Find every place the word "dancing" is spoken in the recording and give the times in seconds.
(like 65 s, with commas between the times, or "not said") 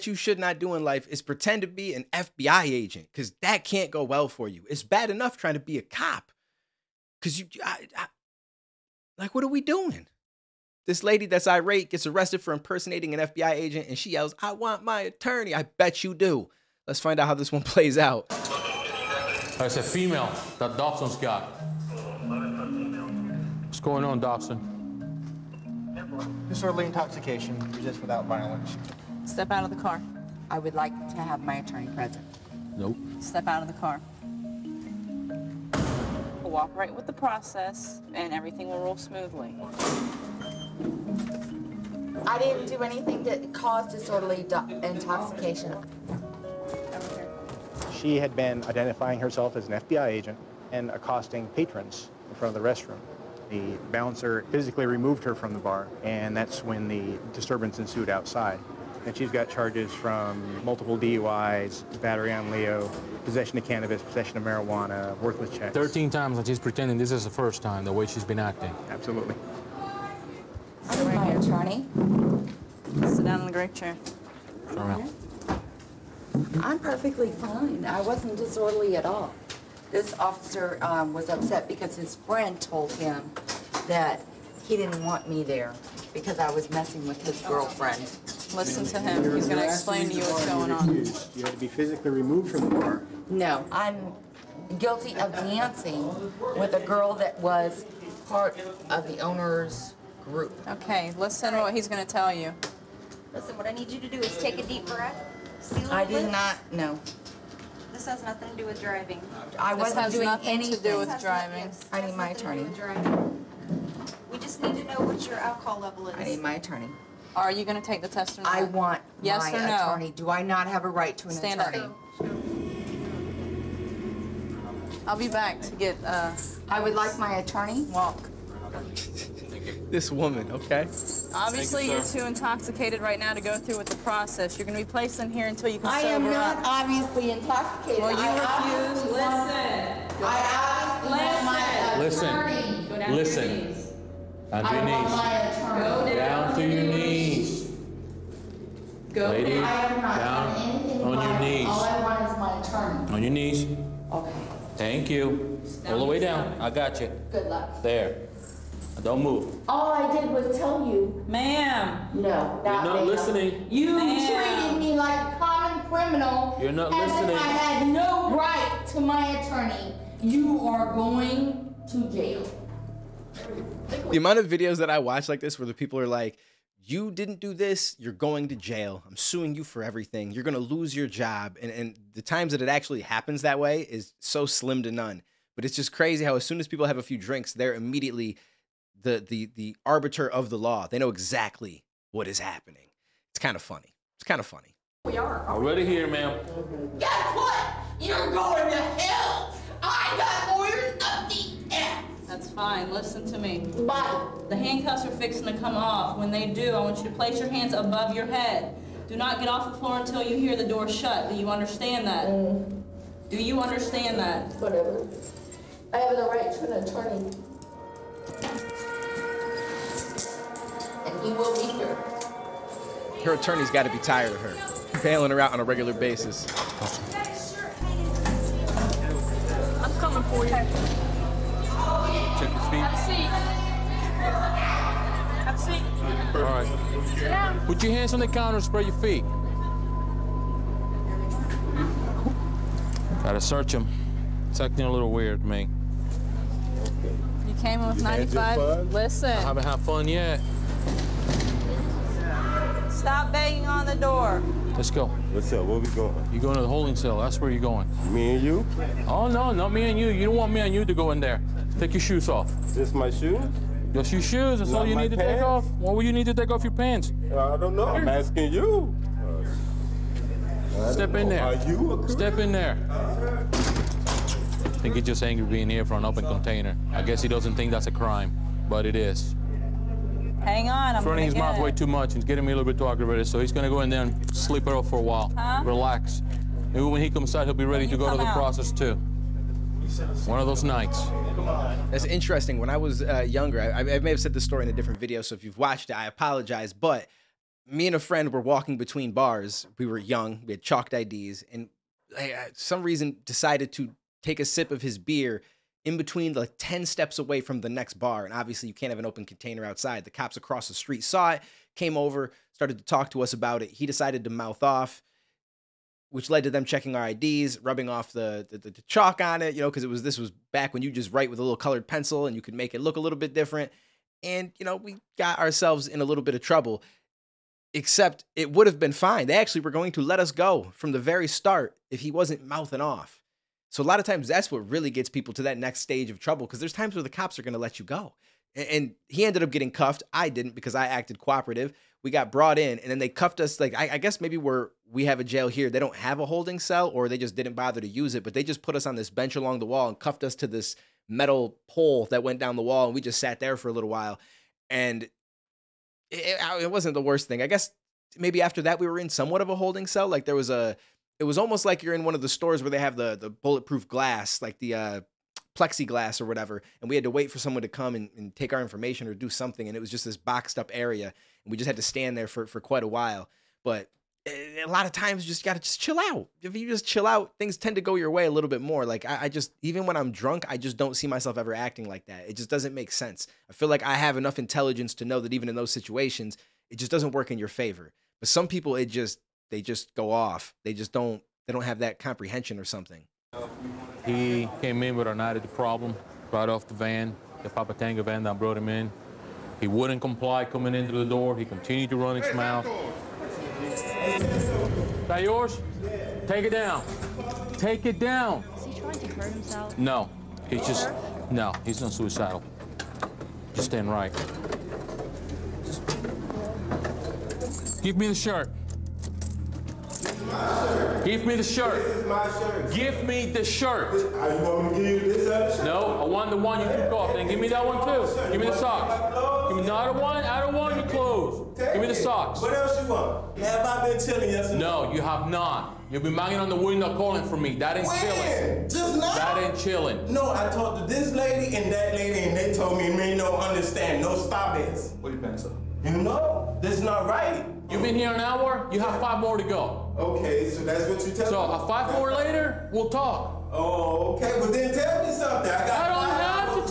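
95 s.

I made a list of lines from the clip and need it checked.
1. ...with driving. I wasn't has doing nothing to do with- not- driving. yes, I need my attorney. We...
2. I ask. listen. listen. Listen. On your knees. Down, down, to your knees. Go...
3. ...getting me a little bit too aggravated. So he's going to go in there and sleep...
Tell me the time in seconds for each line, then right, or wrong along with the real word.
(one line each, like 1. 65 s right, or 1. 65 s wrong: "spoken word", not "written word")
1. 108 s right
2. 140 s right
3. 282 s right.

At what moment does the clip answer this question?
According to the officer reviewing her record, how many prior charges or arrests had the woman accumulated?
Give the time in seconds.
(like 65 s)
65 s.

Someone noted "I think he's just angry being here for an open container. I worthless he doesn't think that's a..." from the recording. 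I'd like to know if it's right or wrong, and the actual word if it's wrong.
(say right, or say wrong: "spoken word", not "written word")
wrong: "guess", not "worthless".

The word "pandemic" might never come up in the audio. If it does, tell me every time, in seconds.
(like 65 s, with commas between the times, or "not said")
not said.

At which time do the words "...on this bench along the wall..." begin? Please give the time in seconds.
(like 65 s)
348 s.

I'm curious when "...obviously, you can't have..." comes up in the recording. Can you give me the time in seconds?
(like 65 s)
308 s.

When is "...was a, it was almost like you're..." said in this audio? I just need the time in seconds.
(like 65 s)
360 s.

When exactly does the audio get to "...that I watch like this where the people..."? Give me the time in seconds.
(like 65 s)
174 s.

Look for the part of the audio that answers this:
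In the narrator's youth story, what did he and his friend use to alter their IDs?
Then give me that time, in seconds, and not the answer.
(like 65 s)
300 s.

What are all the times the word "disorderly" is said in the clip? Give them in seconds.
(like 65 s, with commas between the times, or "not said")
26 s, 43 s, 78 s.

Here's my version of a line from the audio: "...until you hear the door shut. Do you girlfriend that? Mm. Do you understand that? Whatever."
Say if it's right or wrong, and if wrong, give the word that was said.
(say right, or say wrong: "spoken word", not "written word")
wrong: "understand", not "girlfriend".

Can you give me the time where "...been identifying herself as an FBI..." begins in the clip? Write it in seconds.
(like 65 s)
48 s.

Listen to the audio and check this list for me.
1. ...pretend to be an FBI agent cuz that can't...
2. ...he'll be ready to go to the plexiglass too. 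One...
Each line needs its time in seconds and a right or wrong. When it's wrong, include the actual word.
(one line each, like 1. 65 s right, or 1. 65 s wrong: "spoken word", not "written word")
1. 1 s right
2. 287 s wrong: "process", not "plexiglass".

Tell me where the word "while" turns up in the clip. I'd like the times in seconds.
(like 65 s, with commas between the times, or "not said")
285 s, 353 s, 372 s.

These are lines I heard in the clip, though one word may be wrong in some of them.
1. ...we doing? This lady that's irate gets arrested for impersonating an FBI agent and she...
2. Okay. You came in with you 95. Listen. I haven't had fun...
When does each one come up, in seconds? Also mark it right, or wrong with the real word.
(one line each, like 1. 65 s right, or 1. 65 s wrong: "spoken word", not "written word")
1. 9 s right
2. 247 s right.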